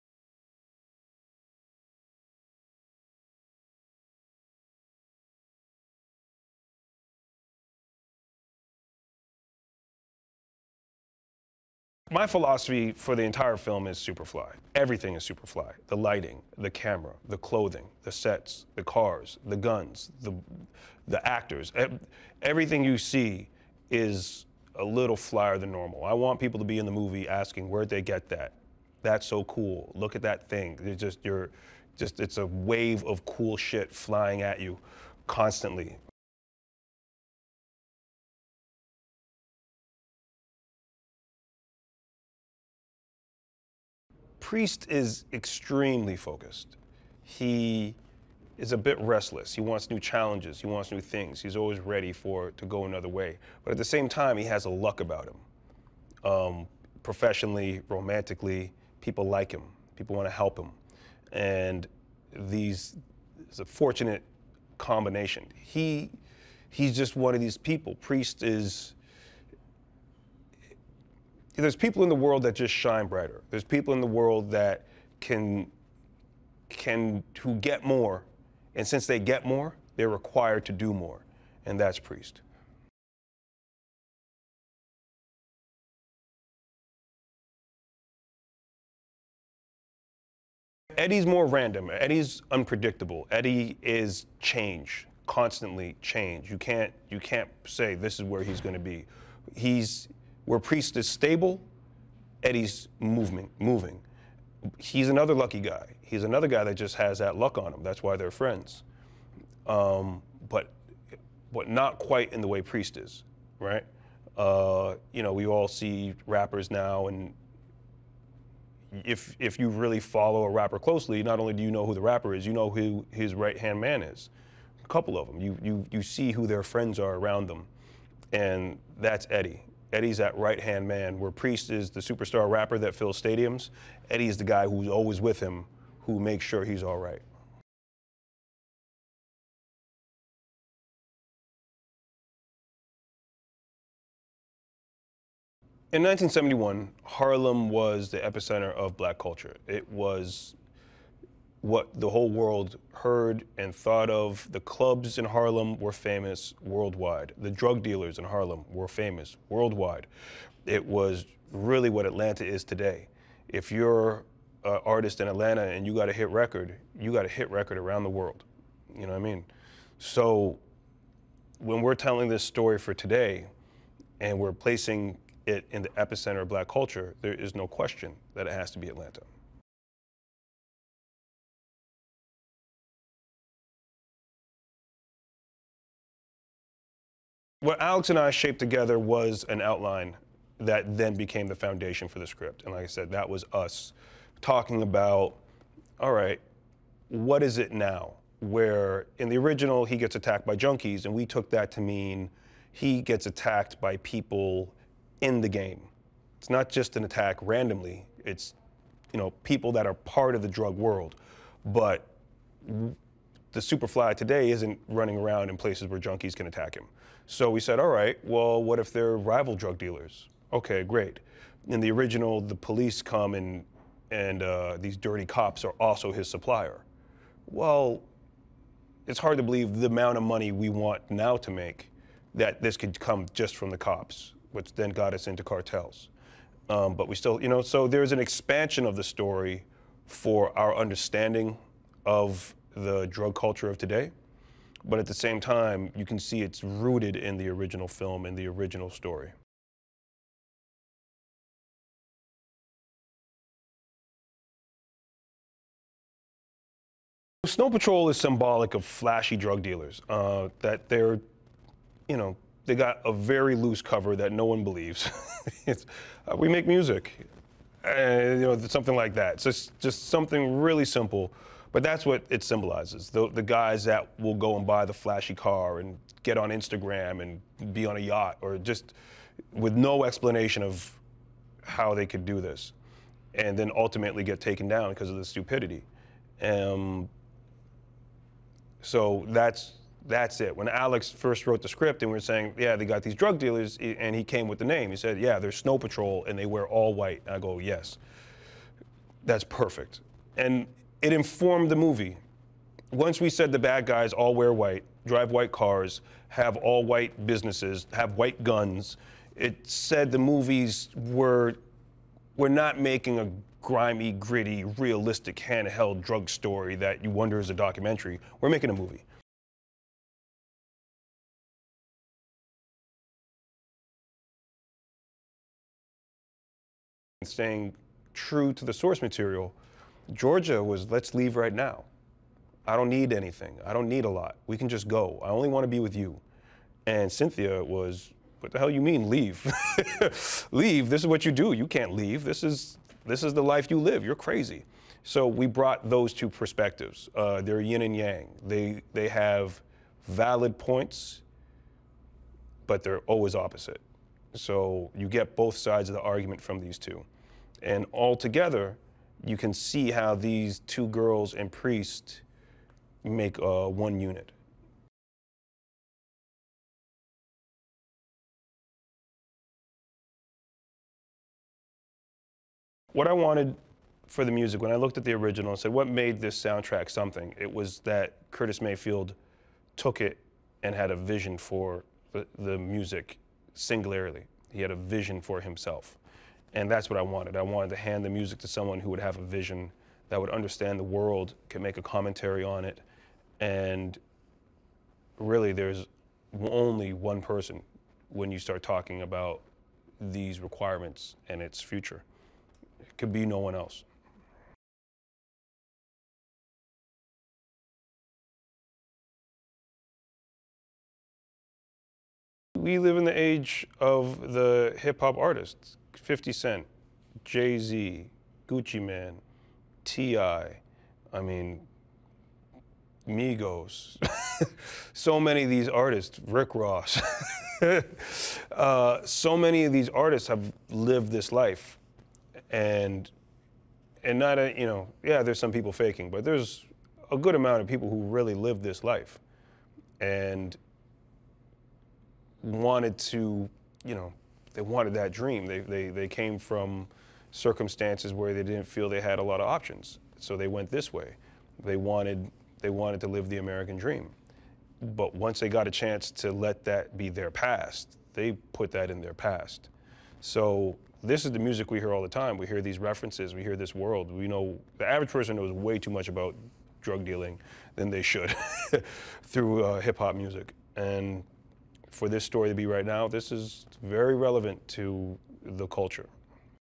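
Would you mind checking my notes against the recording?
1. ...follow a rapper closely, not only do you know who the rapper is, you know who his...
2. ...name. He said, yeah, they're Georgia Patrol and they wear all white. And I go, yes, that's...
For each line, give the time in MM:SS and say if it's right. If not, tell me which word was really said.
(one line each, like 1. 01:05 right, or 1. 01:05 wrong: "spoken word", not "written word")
1. 02:00 right
2. 04:54 wrong: "Snow", not "Georgia".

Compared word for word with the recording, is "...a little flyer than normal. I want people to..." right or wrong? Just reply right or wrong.
right.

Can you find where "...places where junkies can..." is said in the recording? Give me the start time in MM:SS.
03:35.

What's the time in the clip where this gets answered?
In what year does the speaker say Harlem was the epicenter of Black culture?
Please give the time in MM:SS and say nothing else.
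02:26.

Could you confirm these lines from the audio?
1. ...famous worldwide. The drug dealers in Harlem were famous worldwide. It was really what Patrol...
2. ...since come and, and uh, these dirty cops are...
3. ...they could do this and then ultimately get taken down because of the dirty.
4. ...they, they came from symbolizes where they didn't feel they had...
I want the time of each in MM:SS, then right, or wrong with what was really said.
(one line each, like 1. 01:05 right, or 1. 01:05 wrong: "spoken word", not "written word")
1. 02:35 wrong: "Atlanta", not "Patrol"
2. 03:42 wrong: "police", not "since"
3. 04:41 wrong: "stupidity", not "dirty"
4. 07:25 wrong: "circumstances", not "symbolizes".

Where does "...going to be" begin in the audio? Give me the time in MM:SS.
01:38.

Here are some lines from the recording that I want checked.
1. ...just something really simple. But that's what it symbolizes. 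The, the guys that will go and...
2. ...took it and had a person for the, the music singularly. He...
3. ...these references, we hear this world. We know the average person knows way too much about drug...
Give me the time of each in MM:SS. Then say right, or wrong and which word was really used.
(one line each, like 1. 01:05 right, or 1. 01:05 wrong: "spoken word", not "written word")
1. 04:29 right
2. 06:19 wrong: "vision", not "person"
3. 07:42 right.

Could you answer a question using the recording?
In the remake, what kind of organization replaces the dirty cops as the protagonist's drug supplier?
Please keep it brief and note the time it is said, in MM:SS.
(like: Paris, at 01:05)
Cartels, at 03:55.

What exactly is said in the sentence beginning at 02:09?
Eddie's that right hand man, where Priest is the superstar rapper that fills stadiums.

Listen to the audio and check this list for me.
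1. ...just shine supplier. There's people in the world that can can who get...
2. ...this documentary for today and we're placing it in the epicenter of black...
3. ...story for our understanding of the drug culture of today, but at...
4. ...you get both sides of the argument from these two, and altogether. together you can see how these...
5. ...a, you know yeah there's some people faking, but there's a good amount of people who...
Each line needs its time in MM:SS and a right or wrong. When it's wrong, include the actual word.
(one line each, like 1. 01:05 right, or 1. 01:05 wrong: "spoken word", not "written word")
1. 01:12 wrong: "brighter", not "supplier"
2. 02:52 wrong: "story", not "documentary"
3. 03:59 right
4. 05:54 right
5. 07:14 right.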